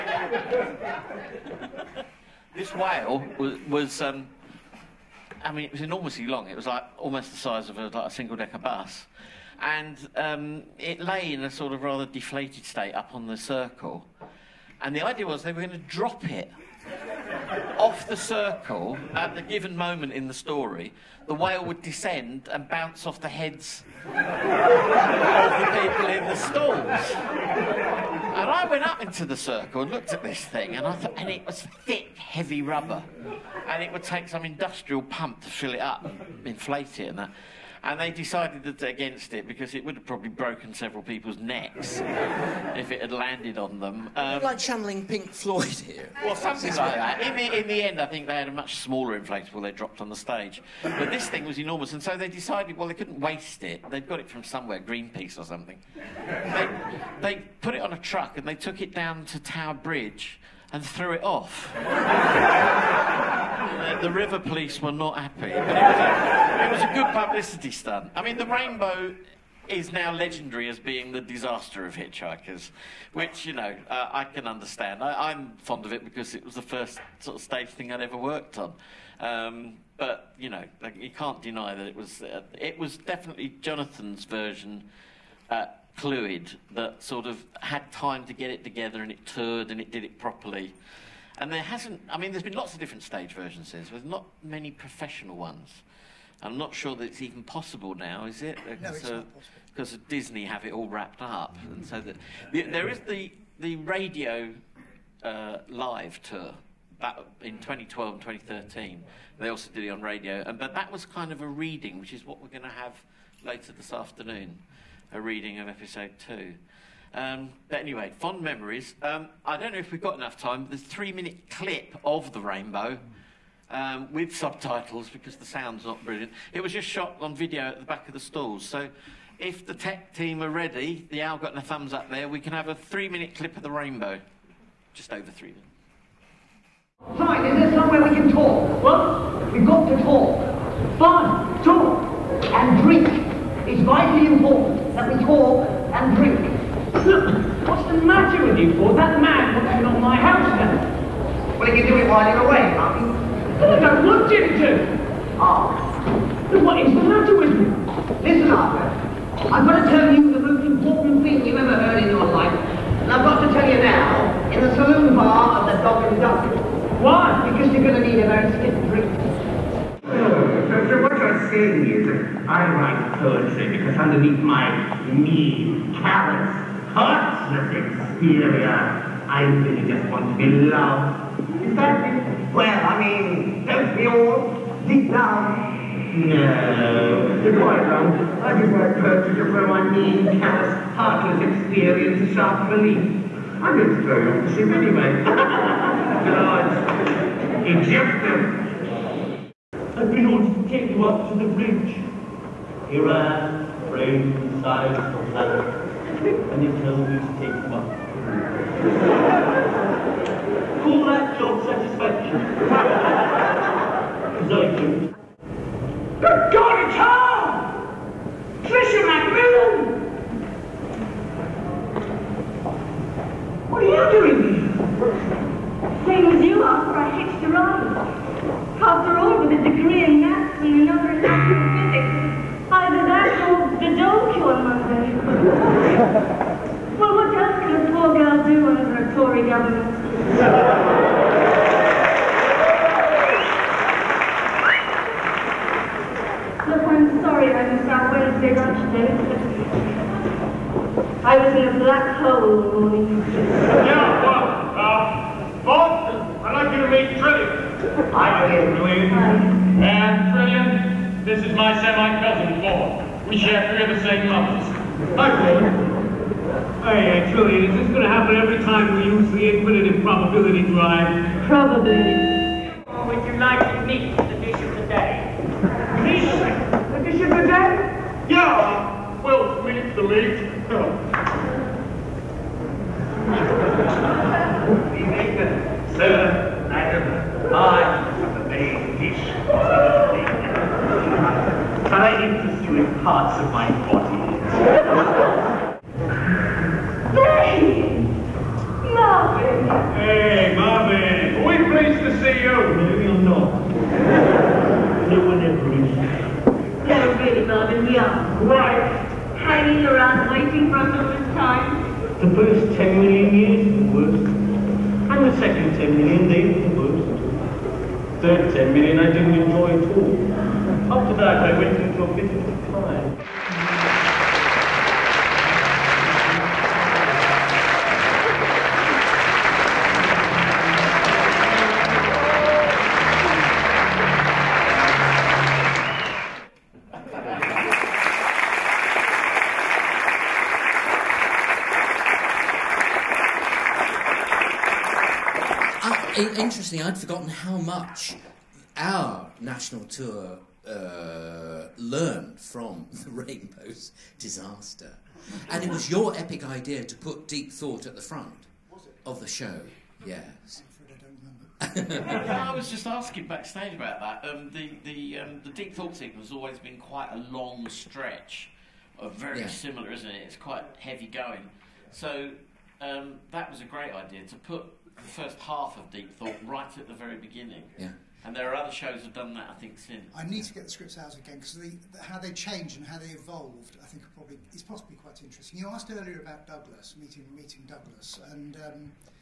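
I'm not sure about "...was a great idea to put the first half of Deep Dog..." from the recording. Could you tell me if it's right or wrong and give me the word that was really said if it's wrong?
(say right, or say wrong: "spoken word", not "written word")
wrong: "Thought", not "Dog".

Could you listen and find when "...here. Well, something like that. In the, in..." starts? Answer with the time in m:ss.
0:45.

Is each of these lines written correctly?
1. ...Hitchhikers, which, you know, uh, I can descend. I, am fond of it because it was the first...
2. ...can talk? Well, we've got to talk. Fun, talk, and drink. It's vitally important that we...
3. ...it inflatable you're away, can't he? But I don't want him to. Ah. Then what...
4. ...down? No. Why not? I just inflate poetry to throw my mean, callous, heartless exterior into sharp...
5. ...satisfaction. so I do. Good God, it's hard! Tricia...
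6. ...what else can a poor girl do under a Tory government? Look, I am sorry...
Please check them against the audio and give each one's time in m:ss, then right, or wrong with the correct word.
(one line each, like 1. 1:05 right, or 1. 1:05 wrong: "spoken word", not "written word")
1. 1:11 wrong: "understand", not "descend"
2. 2:18 right
3. 2:31 wrong: "while", not "inflatable"
4. 3:05 wrong: "write", not "inflate"
5. 3:31 right
6. 3:57 right.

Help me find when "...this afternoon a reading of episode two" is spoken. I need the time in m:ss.
1:53.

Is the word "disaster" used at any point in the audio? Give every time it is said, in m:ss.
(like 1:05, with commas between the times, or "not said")
1:11, 5:54.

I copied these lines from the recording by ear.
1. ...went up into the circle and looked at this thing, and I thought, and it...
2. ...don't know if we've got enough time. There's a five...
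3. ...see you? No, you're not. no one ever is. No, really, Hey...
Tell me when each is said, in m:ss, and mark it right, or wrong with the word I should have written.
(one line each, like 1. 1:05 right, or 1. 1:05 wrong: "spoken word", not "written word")
1. 0:28 right
2. 1:59 wrong: "three", not "five"
3. 5:02 wrong: "Marvin", not "Hey".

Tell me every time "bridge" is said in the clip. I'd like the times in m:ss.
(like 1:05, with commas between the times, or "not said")
0:59, 3:21.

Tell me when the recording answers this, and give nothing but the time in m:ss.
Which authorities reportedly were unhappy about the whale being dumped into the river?
1:04.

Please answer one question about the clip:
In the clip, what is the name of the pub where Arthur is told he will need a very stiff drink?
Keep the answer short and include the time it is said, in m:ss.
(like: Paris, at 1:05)
Dog and Duck, at 2:45.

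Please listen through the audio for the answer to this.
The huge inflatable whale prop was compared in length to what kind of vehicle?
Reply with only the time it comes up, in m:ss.
0:08.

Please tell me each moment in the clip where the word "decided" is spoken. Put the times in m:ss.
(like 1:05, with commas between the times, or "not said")
0:38, 0:52.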